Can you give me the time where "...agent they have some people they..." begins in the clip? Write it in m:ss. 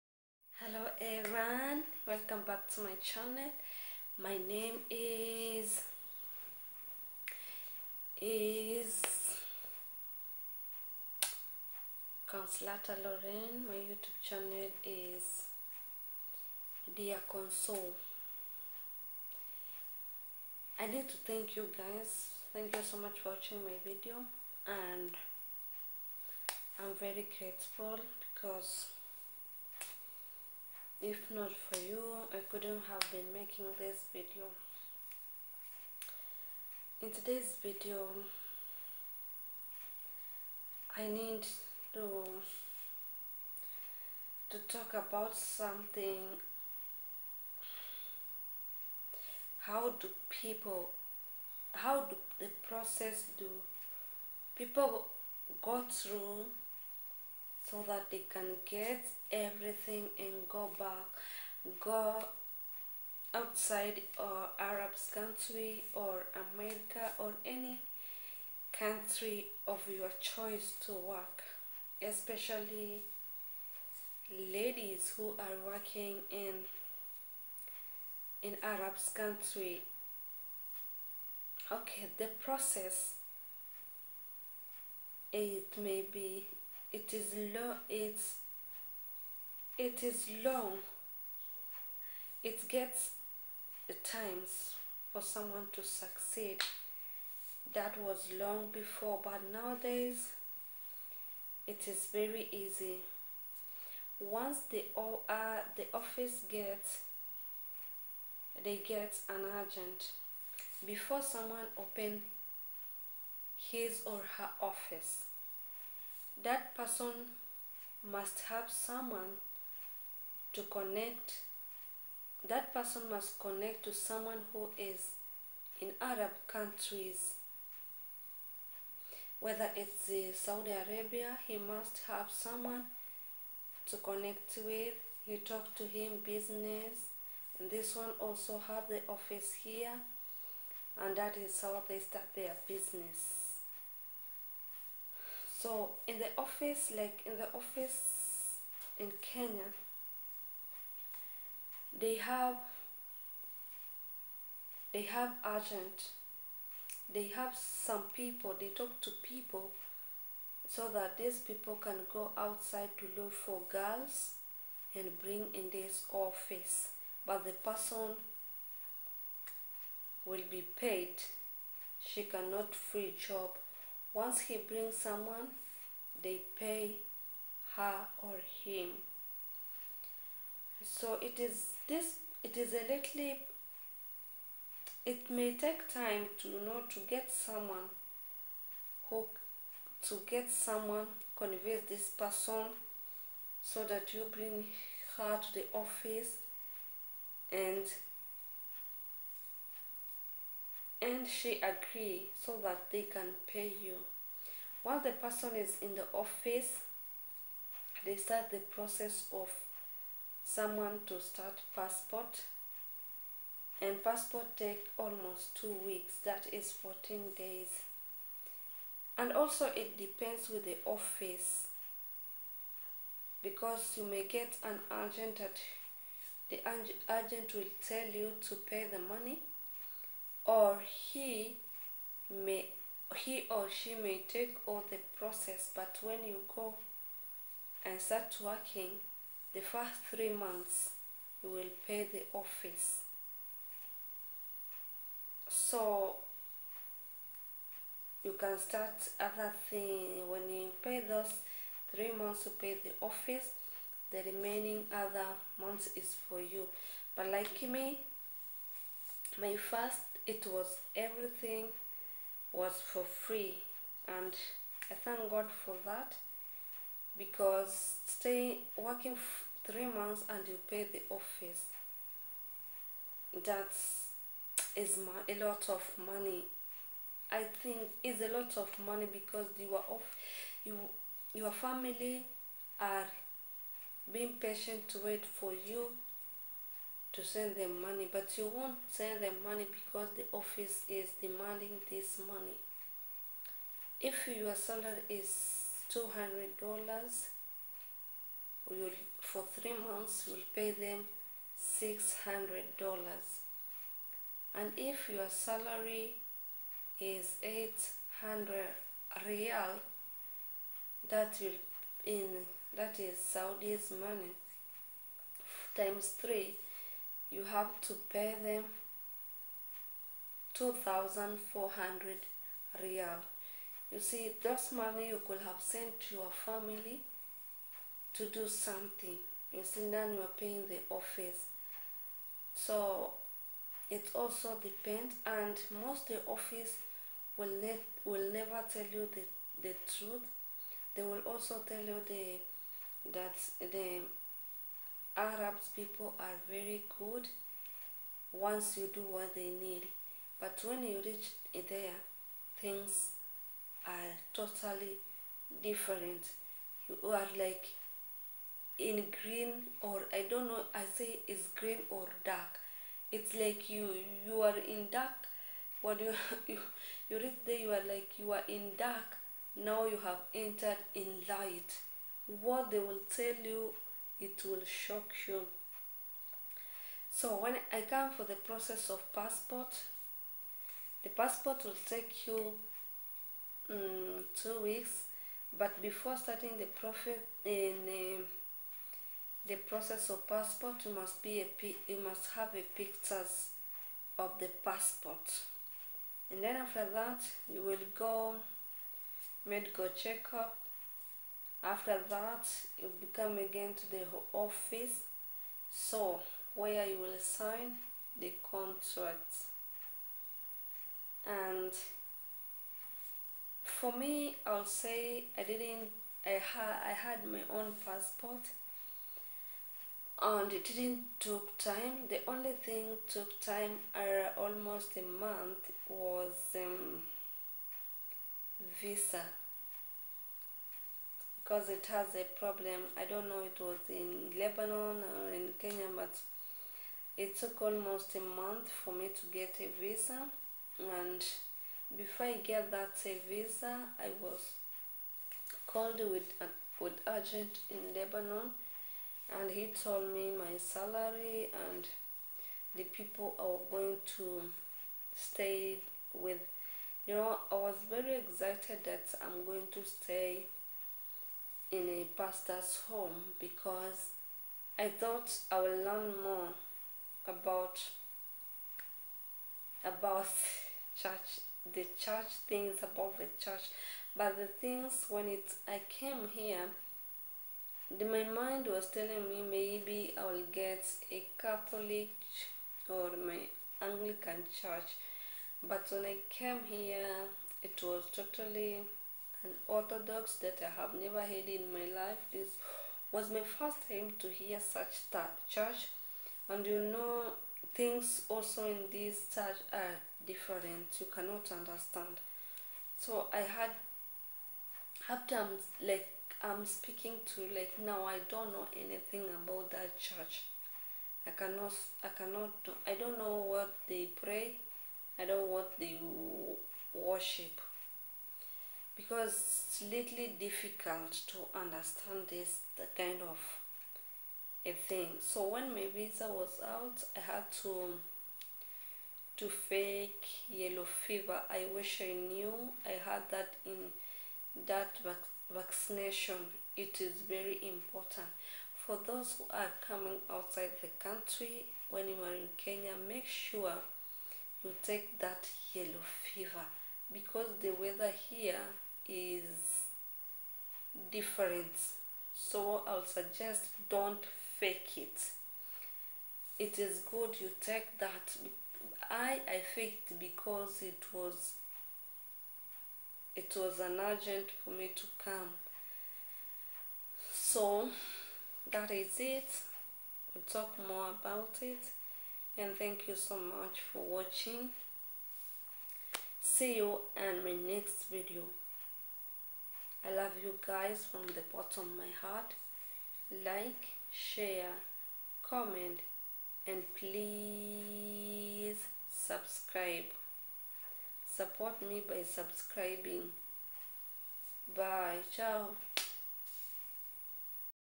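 2:35.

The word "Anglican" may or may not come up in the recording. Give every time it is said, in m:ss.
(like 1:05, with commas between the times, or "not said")
8:03.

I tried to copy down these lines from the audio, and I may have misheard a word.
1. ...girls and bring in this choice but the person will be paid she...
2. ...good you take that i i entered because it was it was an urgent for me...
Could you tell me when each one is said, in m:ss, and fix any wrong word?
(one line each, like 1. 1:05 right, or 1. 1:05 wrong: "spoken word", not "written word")
1. 2:43 wrong: "office", not "choice"
2. 9:17 wrong: "faked", not "entered".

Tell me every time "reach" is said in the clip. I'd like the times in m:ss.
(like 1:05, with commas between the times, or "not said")
5:51, 6:07.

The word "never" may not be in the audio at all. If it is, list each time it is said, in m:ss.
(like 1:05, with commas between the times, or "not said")
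5:38, 8:11.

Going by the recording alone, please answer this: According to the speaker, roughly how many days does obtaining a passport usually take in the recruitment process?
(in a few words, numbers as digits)
14.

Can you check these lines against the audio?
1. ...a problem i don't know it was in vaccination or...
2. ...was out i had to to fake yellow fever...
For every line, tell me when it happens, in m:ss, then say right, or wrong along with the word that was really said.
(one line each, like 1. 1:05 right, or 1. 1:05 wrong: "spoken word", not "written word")
1. 7:12 wrong: "lebanon", not "vaccination"
2. 8:46 right.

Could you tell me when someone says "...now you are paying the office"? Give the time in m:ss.
5:29.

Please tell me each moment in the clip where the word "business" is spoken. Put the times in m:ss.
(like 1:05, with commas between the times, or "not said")
2:16, 2:22.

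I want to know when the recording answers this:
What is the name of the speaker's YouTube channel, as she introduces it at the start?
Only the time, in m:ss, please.
0:16.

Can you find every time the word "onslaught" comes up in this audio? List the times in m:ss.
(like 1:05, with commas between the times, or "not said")
not said.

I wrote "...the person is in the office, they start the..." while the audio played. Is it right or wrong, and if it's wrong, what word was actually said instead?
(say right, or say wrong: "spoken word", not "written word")
right.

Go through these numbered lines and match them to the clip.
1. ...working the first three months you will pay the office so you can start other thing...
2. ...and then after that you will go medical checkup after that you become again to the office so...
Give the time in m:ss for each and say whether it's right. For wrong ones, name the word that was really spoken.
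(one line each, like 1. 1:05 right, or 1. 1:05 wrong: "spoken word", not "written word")
1. 3:58 right
2. 6:36 right.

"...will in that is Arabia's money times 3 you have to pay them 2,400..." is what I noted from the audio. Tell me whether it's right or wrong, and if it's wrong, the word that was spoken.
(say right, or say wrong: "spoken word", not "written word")
wrong: "Saudi", not "Arabia".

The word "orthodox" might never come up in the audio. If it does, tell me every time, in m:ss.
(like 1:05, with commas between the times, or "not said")
8:09.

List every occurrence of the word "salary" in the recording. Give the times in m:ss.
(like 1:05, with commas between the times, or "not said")
4:54, 5:05, 7:30.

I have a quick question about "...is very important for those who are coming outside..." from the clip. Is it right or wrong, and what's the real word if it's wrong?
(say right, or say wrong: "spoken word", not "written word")
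right.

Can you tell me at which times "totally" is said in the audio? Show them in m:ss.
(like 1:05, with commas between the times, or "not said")
5:54, 8:08.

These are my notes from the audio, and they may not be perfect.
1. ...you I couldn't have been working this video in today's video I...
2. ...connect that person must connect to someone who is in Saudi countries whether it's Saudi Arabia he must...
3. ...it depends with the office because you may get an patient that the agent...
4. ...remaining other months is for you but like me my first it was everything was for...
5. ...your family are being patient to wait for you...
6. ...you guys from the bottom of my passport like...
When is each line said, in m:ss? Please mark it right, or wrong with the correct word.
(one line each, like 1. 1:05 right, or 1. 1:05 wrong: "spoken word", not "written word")
1. 0:31 wrong: "making", not "working"
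2. 2:00 wrong: "Arab", not "Saudi"
3. 3:39 wrong: "agent", not "patient"
4. 4:14 right
5. 4:41 right
6. 9:40 wrong: "heart", not "passport".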